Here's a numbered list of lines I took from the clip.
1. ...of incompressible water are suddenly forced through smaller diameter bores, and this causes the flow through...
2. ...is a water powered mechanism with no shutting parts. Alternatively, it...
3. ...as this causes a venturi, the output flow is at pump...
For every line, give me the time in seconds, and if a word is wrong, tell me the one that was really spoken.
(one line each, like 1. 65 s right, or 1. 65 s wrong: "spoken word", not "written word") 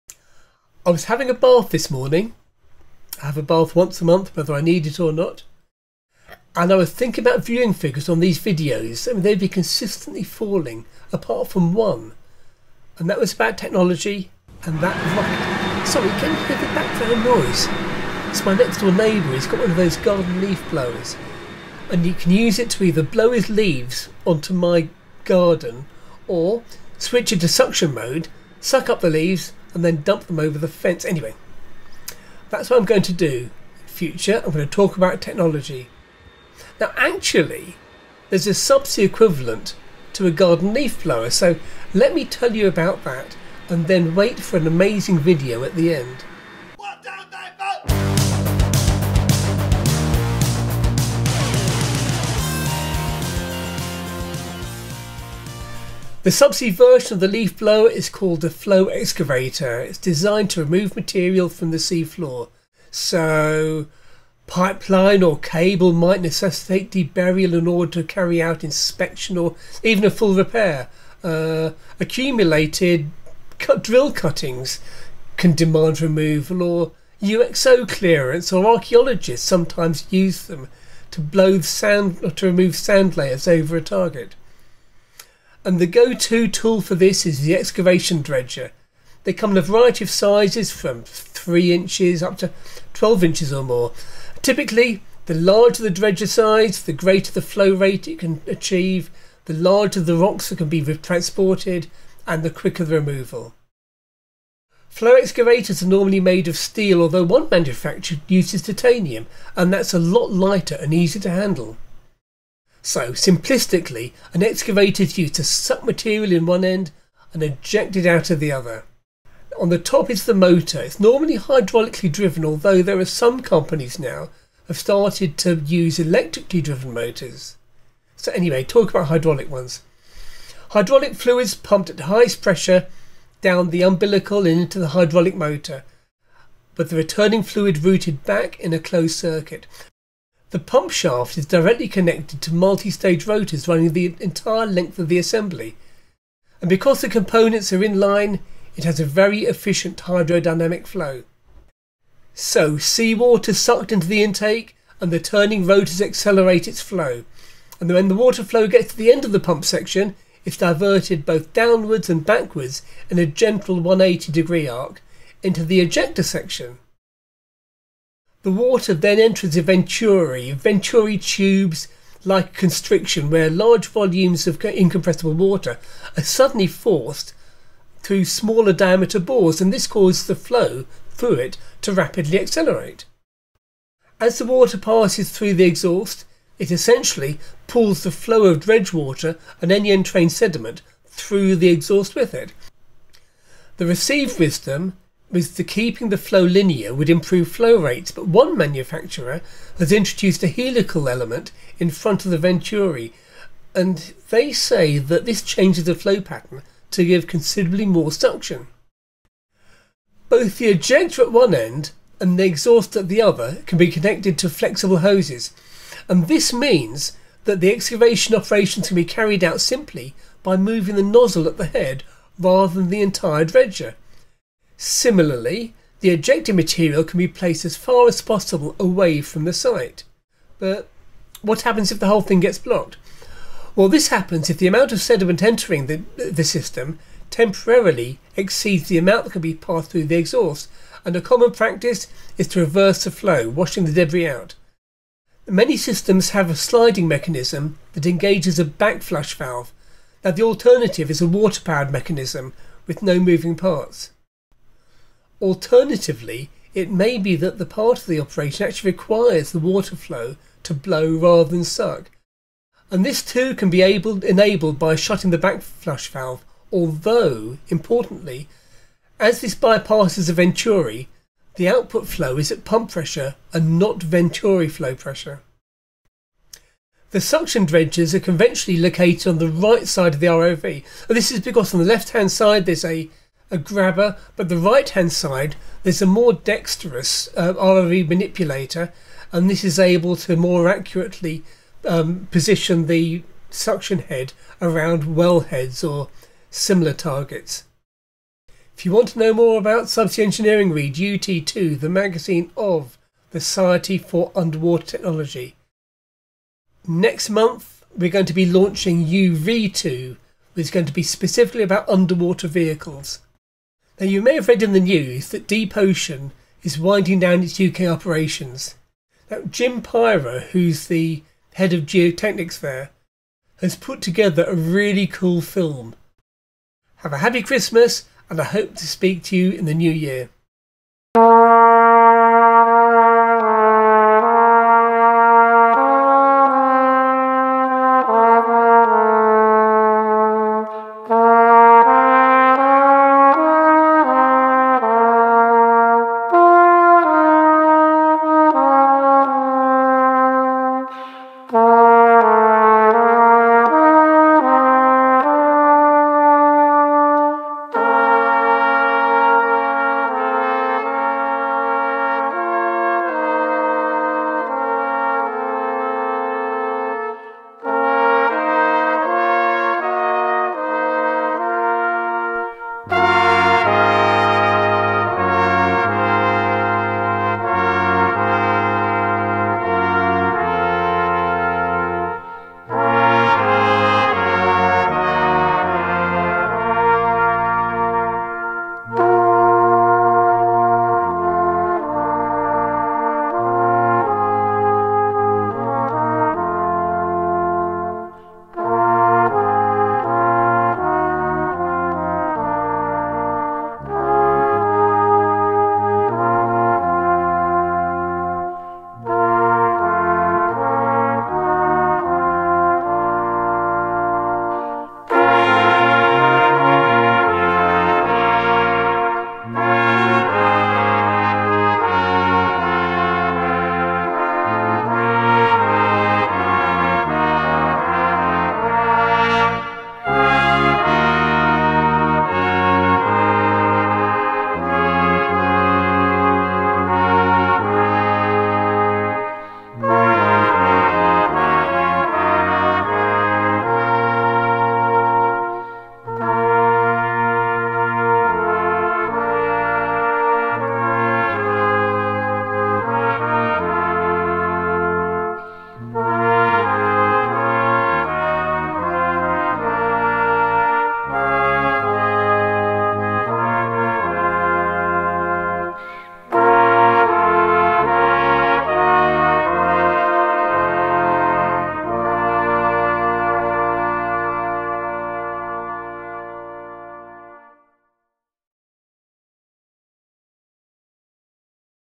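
1. 174 s right
2. 251 s wrong: "moving", not "shutting"
3. 269 s wrong: "bypasses", not "causes".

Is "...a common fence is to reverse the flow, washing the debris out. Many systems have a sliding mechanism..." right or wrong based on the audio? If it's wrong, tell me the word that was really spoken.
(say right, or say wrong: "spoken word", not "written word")
wrong: "practice", not "fence".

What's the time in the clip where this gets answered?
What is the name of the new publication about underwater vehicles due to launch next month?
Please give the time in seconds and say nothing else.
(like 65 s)
309 s.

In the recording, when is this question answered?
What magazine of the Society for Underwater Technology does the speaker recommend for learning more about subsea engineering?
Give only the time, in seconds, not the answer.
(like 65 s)
300 s.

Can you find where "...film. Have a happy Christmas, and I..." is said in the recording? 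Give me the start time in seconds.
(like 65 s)
325 s.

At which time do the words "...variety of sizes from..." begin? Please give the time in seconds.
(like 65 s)
89 s.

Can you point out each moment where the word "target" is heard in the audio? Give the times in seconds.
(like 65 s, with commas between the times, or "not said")
83 s, 296 s.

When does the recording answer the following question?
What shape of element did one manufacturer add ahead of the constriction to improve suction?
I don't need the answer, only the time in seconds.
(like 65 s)
200 s.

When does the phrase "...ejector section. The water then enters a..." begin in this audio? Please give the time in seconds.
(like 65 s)
165 s.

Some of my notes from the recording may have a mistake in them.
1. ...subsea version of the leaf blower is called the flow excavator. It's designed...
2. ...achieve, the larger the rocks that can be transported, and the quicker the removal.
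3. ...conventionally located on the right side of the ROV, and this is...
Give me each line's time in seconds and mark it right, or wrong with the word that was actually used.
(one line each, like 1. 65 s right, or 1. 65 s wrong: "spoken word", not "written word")
1. 56 s right
2. 98 s right
3. 278 s right.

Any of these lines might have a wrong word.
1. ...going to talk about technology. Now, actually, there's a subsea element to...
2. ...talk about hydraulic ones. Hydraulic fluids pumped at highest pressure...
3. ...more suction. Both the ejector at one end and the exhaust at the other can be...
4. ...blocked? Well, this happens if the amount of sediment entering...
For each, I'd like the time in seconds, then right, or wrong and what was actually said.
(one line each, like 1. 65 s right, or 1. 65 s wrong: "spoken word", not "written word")
1. 34 s wrong: "equivalent", not "element"
2. 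128 s right
3. 207 s right
4. 232 s right.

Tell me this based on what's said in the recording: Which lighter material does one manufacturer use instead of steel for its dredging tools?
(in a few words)
Titanium.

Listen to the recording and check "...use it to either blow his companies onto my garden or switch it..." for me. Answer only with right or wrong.
wrong.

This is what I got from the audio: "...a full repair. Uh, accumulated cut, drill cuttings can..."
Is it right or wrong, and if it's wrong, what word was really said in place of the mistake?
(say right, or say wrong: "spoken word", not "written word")
right.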